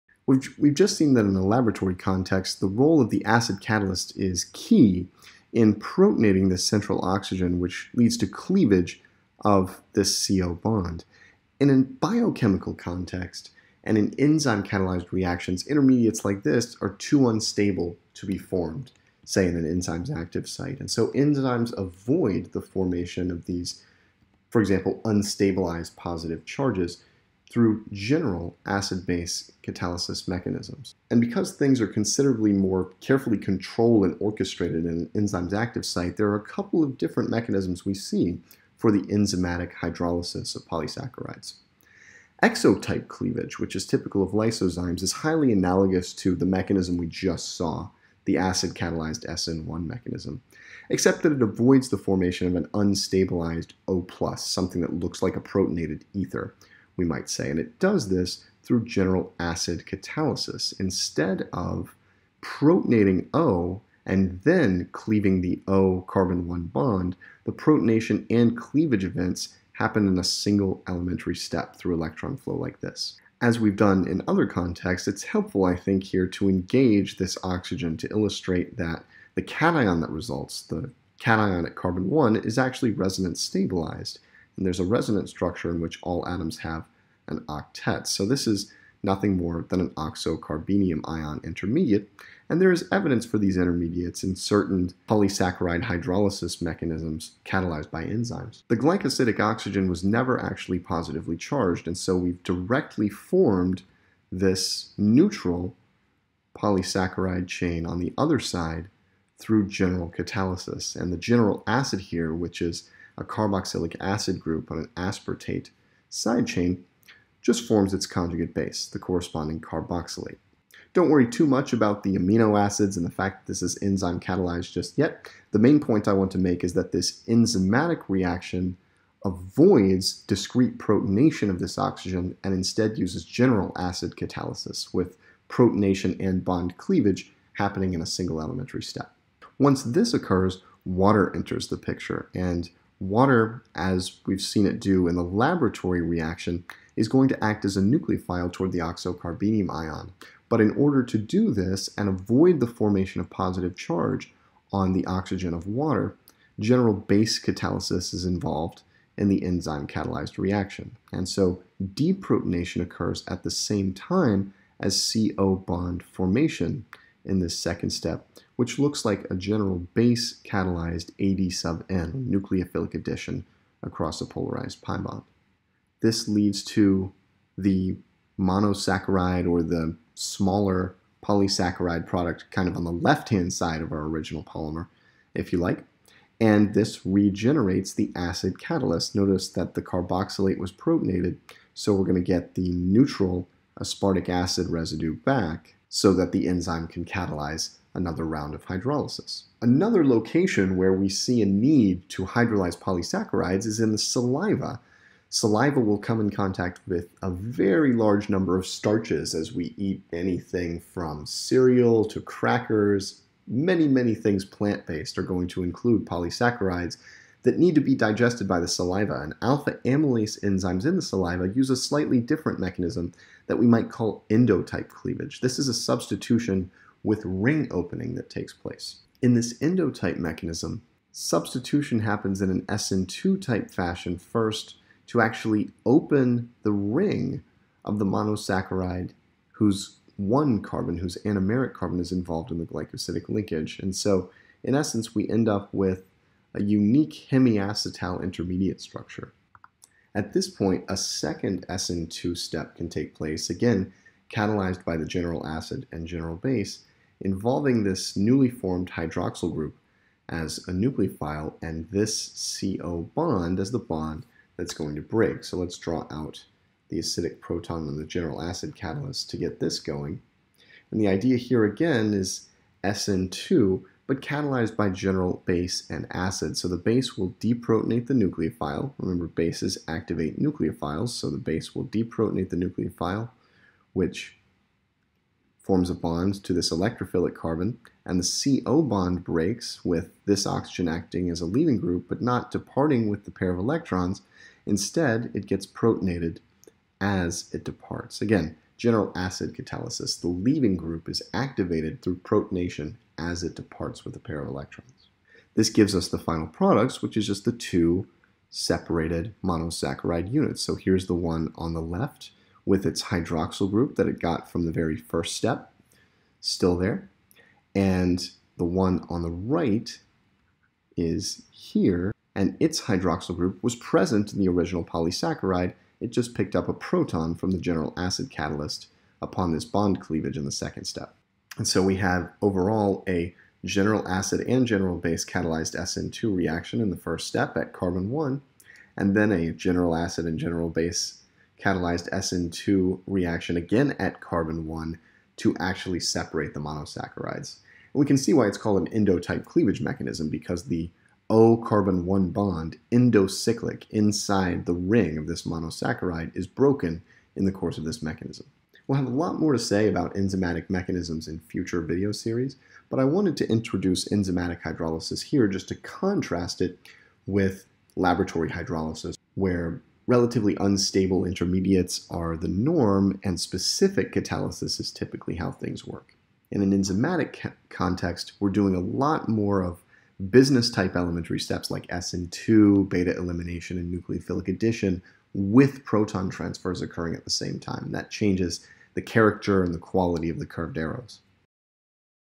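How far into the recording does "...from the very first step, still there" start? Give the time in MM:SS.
05:14.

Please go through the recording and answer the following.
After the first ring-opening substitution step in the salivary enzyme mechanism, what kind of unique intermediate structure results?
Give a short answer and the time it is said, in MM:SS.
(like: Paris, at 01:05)
Hemiacetal, at 04:07.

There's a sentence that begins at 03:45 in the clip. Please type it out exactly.
This is a substitution with ring opening that takes place.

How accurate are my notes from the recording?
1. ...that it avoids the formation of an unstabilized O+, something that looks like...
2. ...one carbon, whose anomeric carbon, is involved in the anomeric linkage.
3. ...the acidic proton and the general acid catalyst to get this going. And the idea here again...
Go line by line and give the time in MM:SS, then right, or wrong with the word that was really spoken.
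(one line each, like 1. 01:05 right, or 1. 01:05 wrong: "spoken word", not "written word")
1. 00:51 right
2. 04:00 wrong: "glycosidic", not "anomeric"
3. 04:26 right.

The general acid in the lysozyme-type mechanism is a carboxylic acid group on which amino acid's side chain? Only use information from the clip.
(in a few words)
Aspartate.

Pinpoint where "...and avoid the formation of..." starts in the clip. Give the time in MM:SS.
02:31.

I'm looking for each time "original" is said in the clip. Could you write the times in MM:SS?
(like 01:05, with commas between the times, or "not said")
03:04, 05:24.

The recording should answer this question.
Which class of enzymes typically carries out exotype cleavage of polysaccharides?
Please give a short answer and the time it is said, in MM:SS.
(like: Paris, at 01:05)
Lysozymes, at 00:44.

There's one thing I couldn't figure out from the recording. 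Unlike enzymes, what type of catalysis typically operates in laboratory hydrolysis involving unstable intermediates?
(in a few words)
Specific catalysis.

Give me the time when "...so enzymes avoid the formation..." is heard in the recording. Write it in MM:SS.
00:20.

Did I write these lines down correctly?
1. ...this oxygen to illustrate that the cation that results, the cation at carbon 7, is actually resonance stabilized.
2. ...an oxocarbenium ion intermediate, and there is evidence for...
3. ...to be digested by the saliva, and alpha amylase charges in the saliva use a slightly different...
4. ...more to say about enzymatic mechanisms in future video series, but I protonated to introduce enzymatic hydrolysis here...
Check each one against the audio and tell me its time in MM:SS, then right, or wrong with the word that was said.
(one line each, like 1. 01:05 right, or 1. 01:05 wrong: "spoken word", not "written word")
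1. 01:17 wrong: "1", not "7"
2. 01:29 right
3. 03:37 wrong: "enzymes", not "charges"
4. 05:59 wrong: "wanted", not "protonated".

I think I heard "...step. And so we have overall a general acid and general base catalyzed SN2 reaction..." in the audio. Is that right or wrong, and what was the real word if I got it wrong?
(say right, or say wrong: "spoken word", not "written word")
right.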